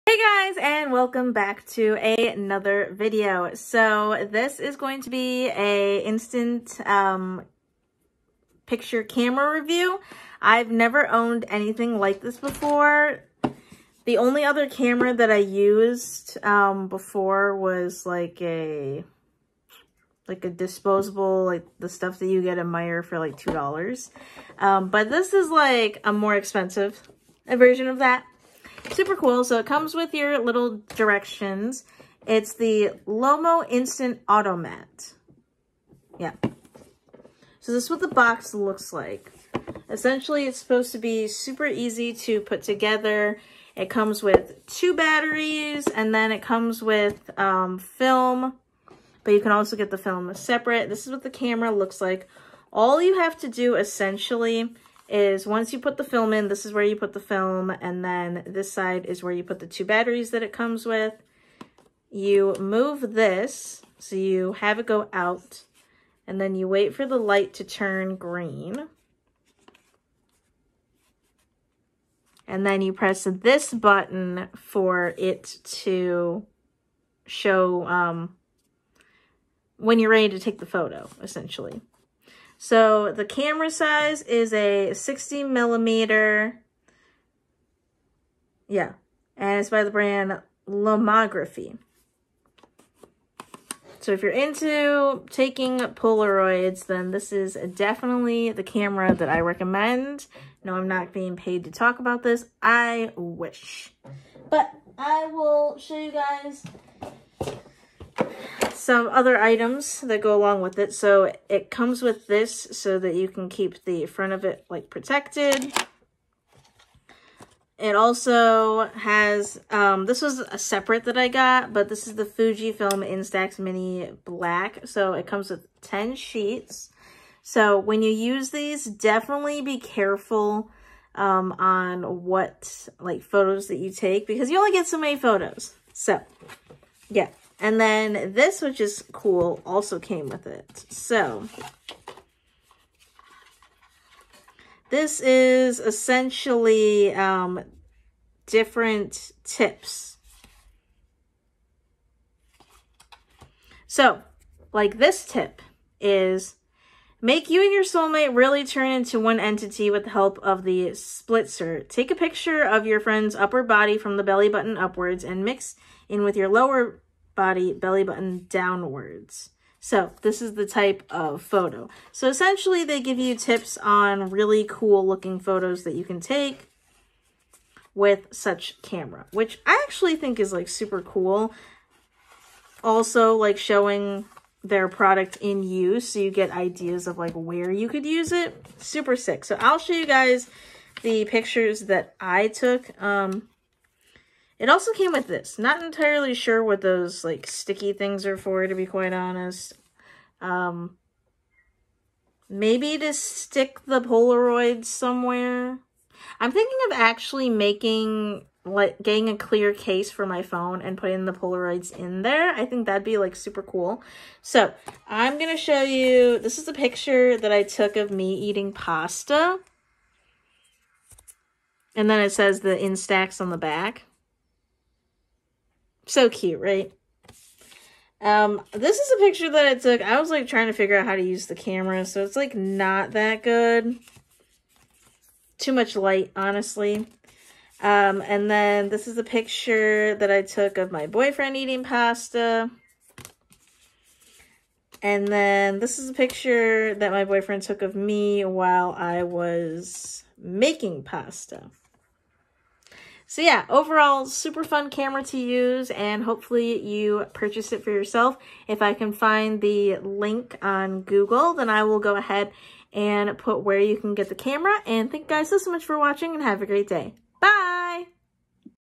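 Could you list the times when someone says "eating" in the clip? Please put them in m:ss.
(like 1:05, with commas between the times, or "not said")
3:38, 4:01.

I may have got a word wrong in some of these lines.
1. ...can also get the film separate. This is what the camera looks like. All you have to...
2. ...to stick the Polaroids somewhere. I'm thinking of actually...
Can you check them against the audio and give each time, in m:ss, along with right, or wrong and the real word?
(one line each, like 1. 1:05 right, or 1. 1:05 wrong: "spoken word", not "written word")
1. 0:49 right
2. 3:22 right.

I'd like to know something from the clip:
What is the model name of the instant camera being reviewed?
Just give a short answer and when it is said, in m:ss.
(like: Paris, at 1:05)
Lomo Instant Automat, at 0:33.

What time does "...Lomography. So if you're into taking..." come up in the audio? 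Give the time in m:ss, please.
1:30.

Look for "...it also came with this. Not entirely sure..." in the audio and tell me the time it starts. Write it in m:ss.
3:14.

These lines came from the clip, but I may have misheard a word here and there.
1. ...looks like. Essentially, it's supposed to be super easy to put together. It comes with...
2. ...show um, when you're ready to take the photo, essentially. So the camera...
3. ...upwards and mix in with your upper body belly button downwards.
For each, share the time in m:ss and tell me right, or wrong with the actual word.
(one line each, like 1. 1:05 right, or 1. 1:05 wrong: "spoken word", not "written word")
1. 0:38 right
2. 1:17 right
3. 2:44 wrong: "lower", not "upper".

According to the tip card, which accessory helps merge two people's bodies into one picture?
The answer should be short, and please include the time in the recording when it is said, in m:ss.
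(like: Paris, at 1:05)
splitzer, at 2:40.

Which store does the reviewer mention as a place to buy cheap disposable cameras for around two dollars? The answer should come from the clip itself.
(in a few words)
Meijer.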